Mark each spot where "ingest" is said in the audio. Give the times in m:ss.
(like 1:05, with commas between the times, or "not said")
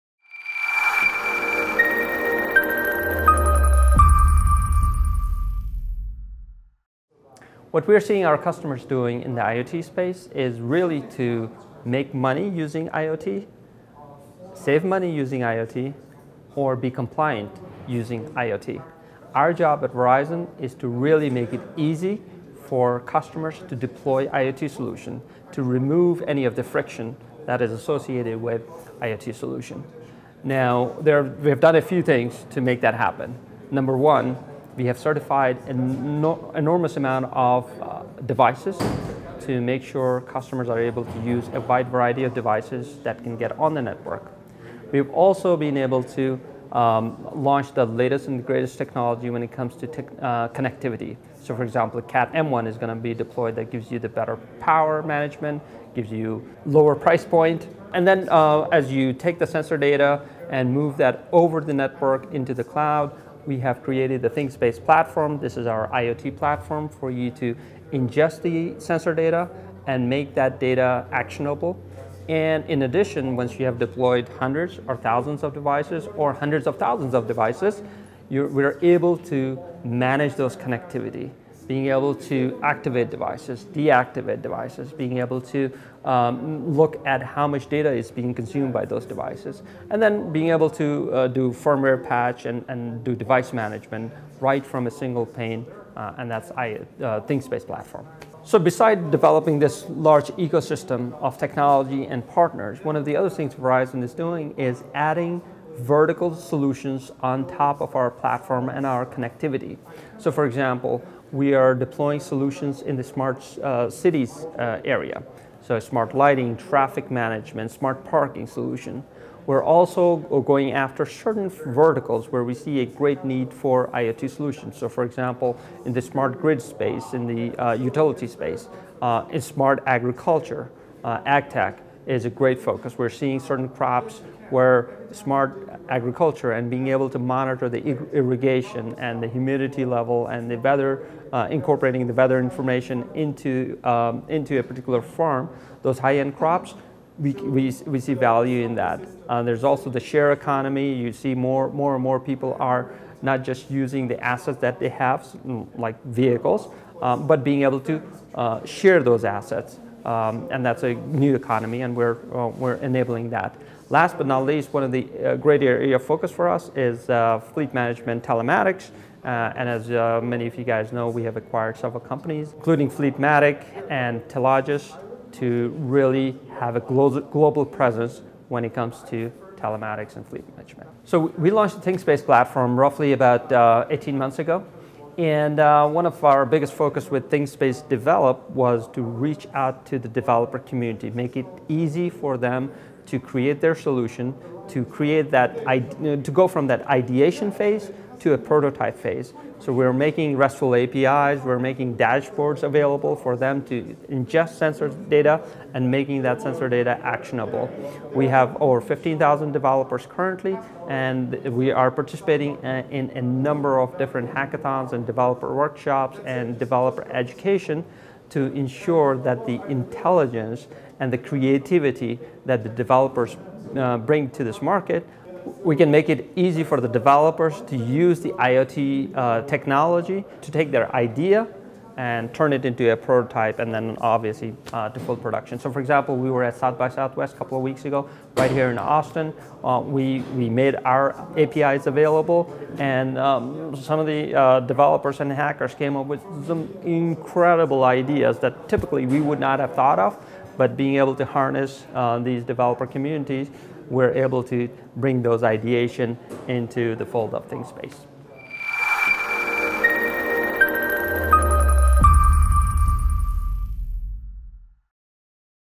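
1:07, 3:24.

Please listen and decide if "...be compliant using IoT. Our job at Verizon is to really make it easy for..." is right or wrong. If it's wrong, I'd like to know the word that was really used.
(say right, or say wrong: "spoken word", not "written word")
right.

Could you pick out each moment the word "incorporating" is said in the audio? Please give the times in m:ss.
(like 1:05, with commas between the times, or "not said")
2:21.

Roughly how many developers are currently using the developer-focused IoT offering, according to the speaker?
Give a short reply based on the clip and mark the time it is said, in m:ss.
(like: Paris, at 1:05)
15,000, at 3:28.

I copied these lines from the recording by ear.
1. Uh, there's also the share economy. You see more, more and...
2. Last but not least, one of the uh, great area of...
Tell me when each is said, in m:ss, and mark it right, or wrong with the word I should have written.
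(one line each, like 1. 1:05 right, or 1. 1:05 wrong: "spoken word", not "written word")
1. 2:29 right
2. 2:43 right.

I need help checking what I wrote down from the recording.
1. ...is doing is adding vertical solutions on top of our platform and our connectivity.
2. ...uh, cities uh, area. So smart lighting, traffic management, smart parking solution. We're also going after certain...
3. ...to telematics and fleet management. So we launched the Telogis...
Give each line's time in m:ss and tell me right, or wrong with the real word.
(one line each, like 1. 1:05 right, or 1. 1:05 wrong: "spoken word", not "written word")
1. 1:44 right
2. 1:53 right
3. 2:59 wrong: "ThingSpace", not "Telogis".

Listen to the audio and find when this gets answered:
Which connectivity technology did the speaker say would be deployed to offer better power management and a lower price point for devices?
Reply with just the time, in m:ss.
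0:52.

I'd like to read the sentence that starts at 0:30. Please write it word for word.
Now, there, we have done a few things to make that happen.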